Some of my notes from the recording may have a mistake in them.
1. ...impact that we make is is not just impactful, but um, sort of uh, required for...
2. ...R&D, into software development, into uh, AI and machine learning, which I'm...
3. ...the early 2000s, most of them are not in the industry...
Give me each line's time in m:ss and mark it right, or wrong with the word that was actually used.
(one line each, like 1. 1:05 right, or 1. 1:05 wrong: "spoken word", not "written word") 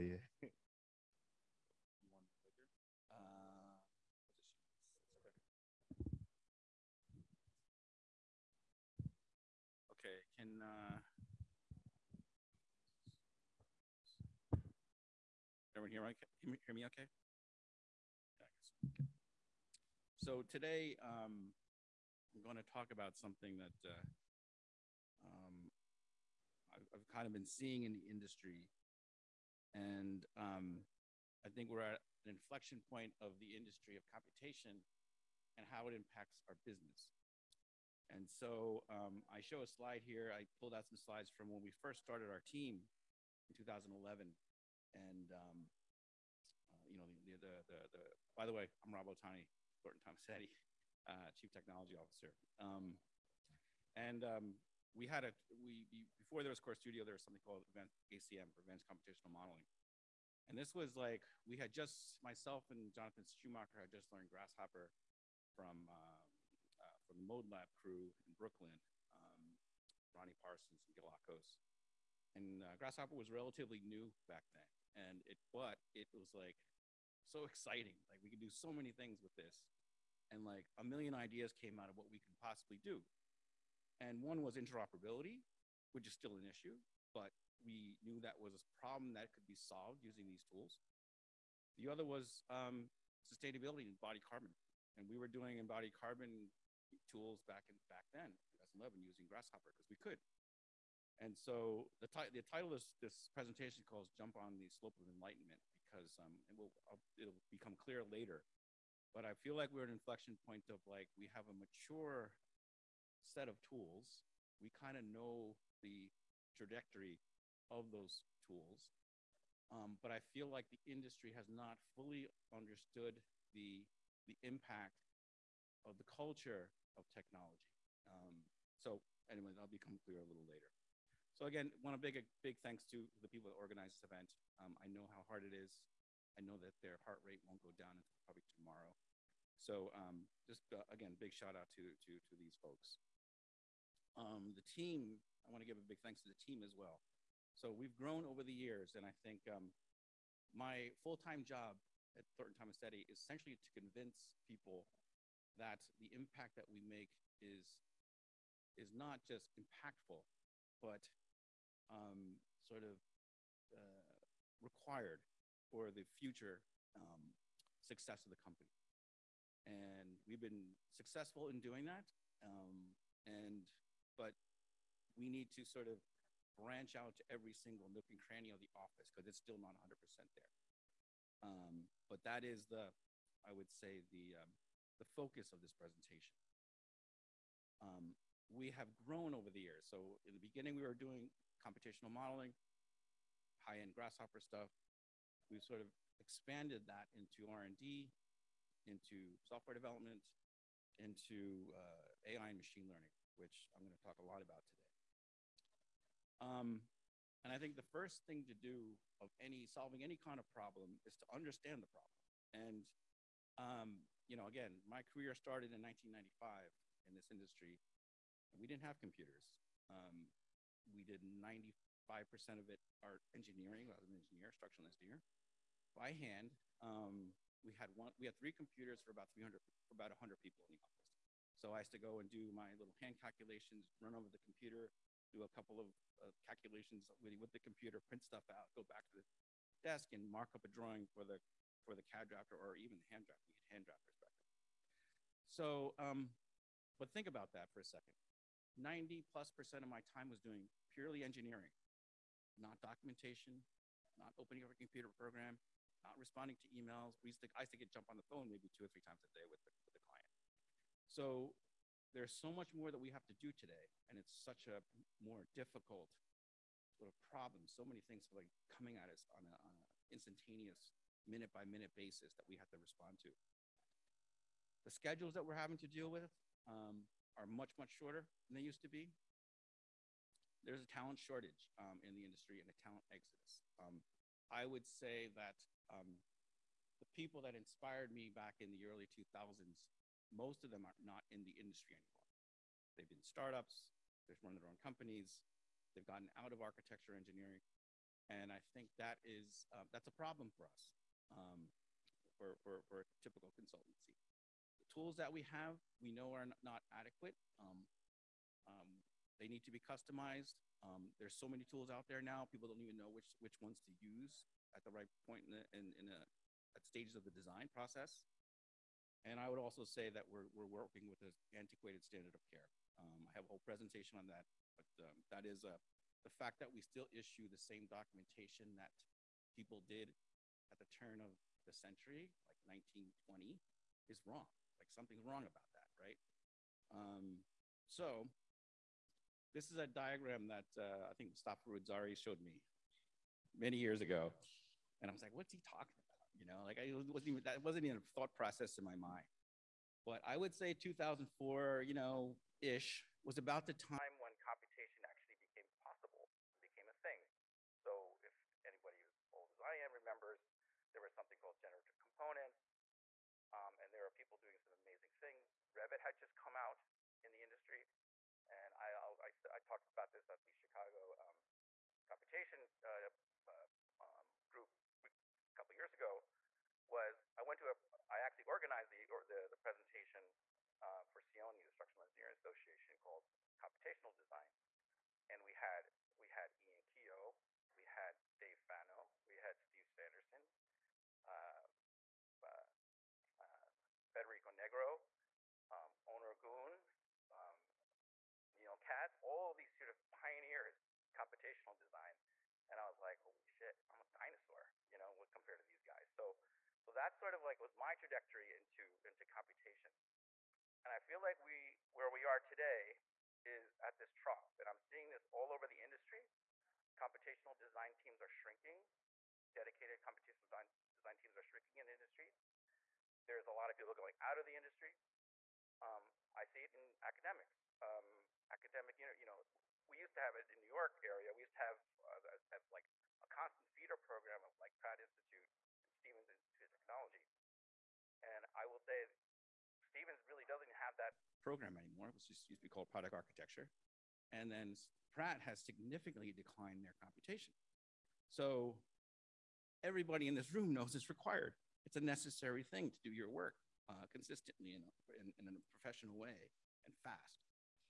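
1. 2:36 right
2. 3:17 right
3. 4:48 right.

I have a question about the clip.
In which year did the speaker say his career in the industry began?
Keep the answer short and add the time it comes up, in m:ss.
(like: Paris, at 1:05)
1995, at 3:35.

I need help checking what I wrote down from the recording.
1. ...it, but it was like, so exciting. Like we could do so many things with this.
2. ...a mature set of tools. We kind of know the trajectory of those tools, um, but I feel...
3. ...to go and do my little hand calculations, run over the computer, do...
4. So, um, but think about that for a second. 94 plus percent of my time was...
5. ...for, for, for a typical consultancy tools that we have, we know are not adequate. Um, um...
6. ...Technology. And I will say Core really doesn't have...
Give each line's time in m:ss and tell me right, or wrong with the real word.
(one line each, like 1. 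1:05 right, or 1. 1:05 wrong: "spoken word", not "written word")
1. 1:15 right
2. 1:51 right
3. 3:51 right
4. 4:05 wrong: "90", not "94"
5. 5:02 right
6. 7:16 wrong: "Stevens", not "Core".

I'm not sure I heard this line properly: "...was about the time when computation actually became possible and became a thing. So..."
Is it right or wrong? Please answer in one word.
right.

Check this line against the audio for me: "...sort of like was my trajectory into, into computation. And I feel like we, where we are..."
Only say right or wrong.
right.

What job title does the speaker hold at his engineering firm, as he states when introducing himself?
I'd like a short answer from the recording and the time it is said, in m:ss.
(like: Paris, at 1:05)
Chief Technology Officer, at 0:51.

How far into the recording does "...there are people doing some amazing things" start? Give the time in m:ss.
6:03.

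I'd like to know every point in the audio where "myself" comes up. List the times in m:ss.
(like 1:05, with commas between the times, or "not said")
1:02.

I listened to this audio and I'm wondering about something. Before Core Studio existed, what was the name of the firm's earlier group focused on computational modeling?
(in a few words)
Event ACM.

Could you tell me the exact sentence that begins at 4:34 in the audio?
The schedules that we're having to deal with, um, are much, much shorter than they used to be.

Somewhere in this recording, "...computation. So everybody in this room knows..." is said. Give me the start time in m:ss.
7:27.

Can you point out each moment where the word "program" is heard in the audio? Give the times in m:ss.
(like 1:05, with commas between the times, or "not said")
4:15, 7:13, 7:21.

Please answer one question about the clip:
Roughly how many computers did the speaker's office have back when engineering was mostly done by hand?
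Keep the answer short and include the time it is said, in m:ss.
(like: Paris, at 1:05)
3, at 3:48.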